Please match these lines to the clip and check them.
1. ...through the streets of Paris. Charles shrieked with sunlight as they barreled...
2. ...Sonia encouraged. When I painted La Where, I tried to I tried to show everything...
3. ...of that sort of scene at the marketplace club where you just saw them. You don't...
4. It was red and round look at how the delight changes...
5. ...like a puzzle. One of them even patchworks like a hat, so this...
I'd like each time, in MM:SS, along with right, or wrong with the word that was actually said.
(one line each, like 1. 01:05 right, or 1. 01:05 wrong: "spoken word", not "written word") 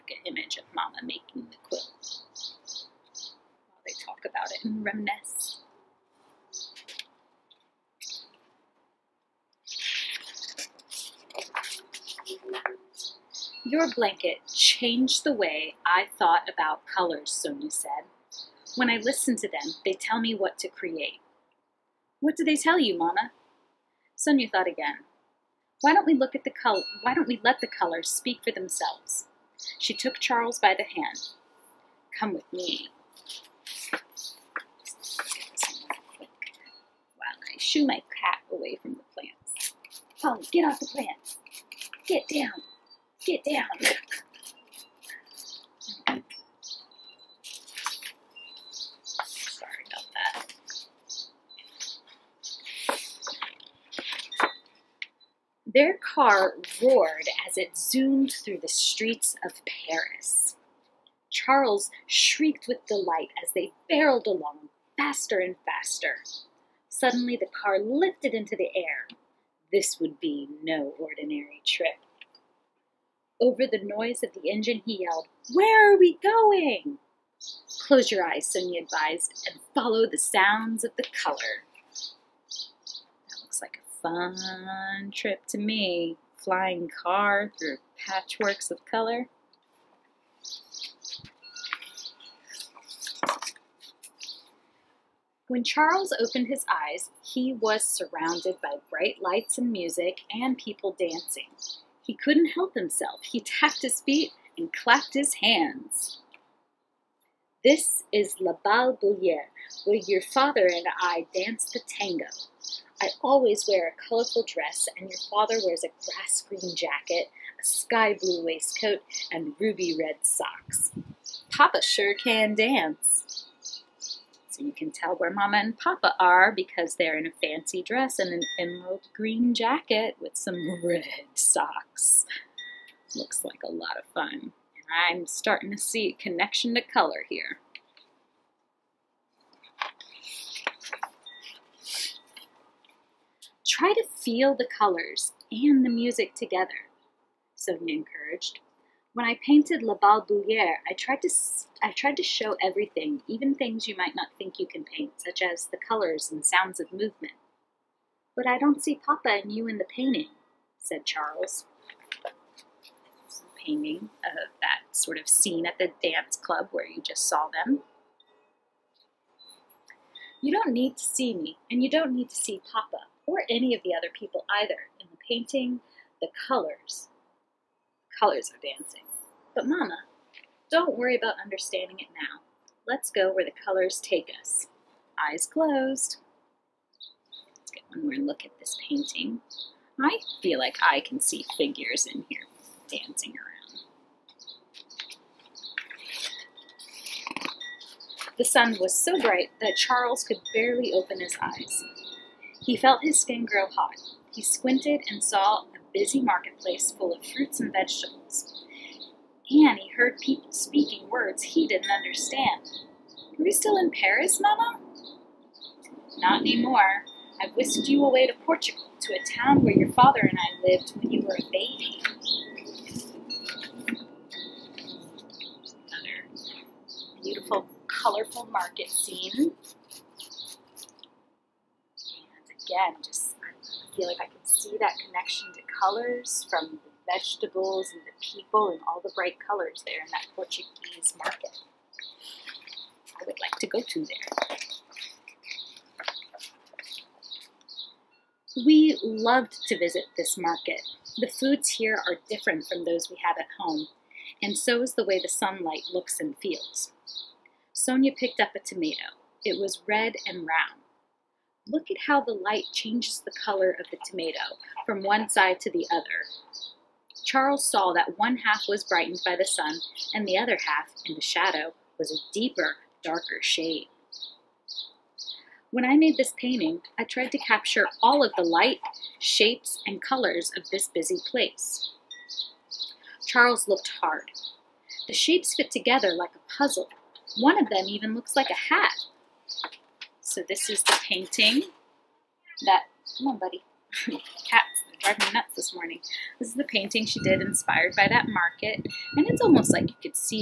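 1. 00:58 wrong: "delight", not "sunlight"
2. 02:27 wrong: "Bouillere", not "Where"
3. 02:44 wrong: "dance", not "marketplace"
4. 04:19 wrong: "light", not "delight"
5. 04:46 wrong: "looks", not "patchworks".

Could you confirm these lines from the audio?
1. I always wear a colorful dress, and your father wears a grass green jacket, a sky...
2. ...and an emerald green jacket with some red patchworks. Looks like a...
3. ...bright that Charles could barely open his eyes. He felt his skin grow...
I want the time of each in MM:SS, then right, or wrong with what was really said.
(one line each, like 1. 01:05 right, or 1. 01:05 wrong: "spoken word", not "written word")
1. 01:53 right
2. 02:08 wrong: "socks", not "patchworks"
3. 03:19 right.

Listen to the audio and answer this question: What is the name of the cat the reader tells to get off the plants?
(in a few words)
Polly.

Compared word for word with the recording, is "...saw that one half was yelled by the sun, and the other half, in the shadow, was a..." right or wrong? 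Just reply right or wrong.
wrong.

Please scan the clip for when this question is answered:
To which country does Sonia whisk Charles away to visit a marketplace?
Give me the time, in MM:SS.
03:38.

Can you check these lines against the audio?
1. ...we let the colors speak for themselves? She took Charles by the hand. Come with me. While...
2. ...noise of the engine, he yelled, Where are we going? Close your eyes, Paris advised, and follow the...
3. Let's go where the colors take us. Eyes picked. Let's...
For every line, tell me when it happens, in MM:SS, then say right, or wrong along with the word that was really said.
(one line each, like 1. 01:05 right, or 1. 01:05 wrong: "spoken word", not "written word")
1. 00:27 right
2. 01:13 wrong: "Sonia", not "Paris"
3. 03:02 wrong: "closed", not "picked".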